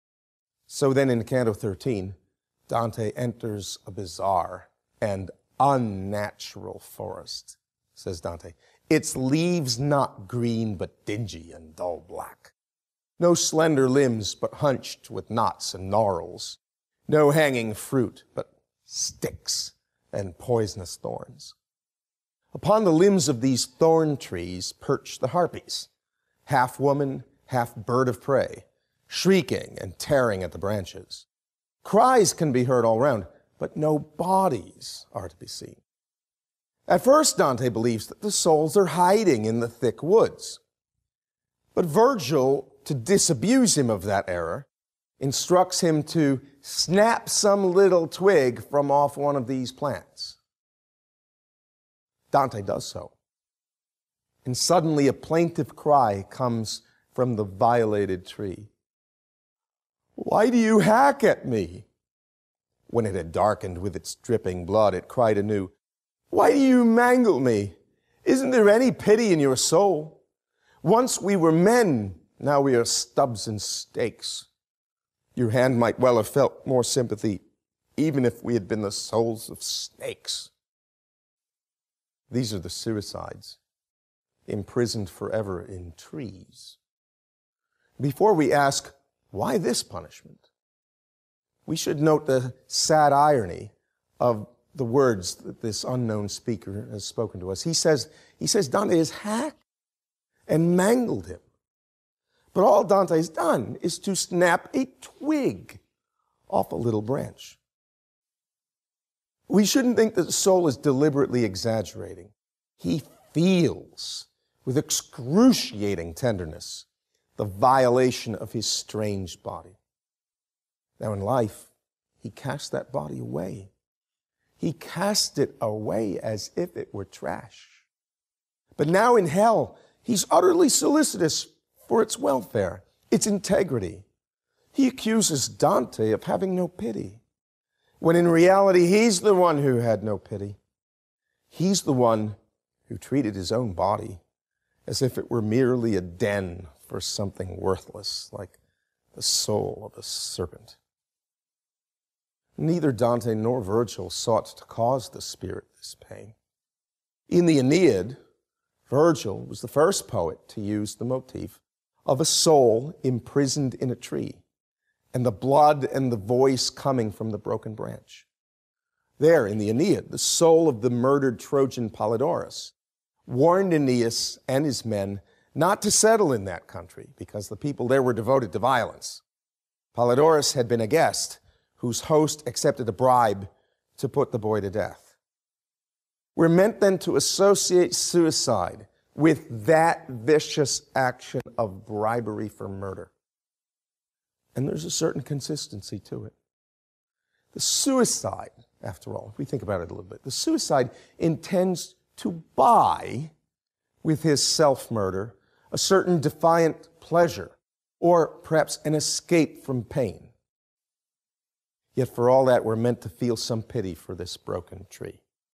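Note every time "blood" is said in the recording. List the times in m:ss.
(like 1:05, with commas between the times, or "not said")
1:04, 2:45.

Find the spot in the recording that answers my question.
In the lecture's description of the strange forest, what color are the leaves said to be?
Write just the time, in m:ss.
0:11.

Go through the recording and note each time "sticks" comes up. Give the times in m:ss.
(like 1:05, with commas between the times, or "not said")
0:18.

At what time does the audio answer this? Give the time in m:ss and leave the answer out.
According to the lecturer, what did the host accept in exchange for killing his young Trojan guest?
3:02.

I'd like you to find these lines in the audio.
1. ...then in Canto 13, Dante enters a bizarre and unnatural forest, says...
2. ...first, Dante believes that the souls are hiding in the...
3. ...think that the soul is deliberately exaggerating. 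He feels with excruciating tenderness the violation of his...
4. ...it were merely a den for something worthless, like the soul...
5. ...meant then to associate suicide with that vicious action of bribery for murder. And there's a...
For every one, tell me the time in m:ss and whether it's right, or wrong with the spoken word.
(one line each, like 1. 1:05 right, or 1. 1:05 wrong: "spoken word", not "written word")
1. 0:00 right
2. 0:37 right
3. 1:49 right
4. 2:25 right
5. 3:06 right.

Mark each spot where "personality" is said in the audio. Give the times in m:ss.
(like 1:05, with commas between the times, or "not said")
not said.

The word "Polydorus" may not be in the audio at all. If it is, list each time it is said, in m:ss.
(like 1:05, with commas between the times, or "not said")
2:51, 2:59.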